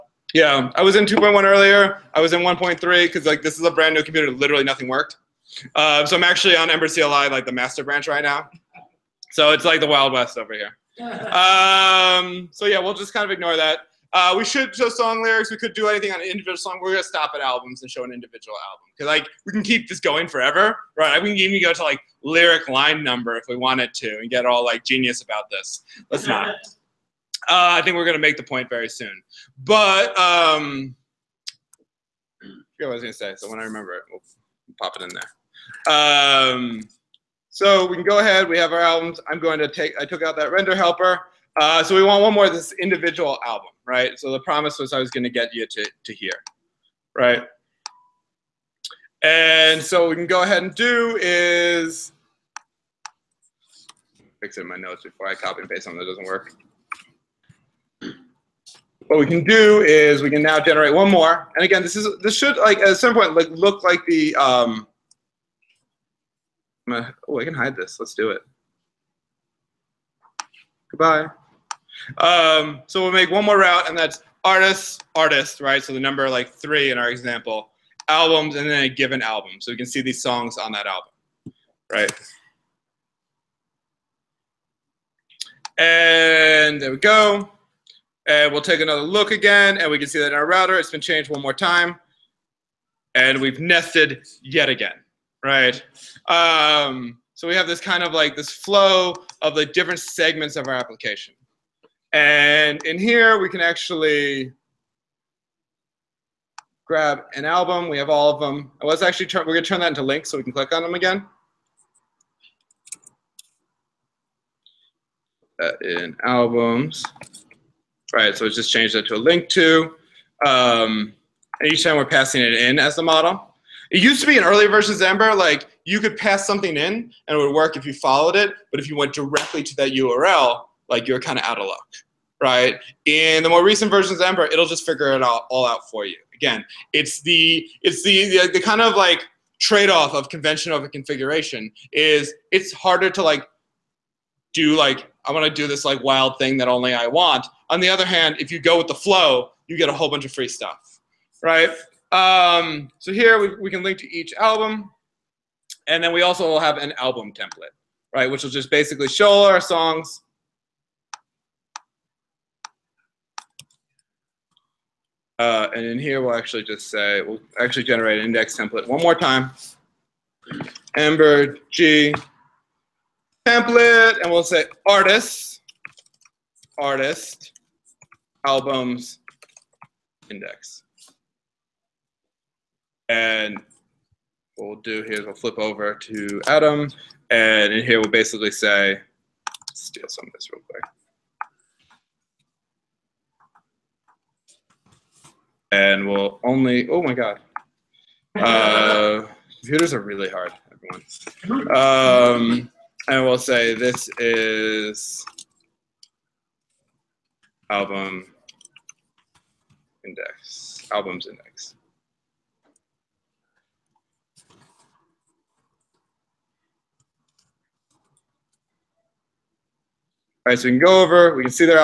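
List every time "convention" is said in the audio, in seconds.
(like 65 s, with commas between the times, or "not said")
140 s.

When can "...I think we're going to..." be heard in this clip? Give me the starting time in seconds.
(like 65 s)
27 s.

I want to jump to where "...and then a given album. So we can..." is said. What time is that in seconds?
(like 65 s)
78 s.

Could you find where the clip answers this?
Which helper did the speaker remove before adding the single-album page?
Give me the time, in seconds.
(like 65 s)
40 s.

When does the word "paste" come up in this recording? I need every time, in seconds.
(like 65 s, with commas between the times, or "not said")
55 s.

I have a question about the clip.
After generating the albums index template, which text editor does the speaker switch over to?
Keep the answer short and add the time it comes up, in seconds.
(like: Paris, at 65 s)
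Atom, at 186 s.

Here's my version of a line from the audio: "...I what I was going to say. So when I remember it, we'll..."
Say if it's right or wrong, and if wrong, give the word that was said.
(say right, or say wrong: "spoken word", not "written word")
right.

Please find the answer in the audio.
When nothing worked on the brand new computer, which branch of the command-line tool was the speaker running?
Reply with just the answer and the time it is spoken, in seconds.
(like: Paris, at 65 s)
master, at 7 s.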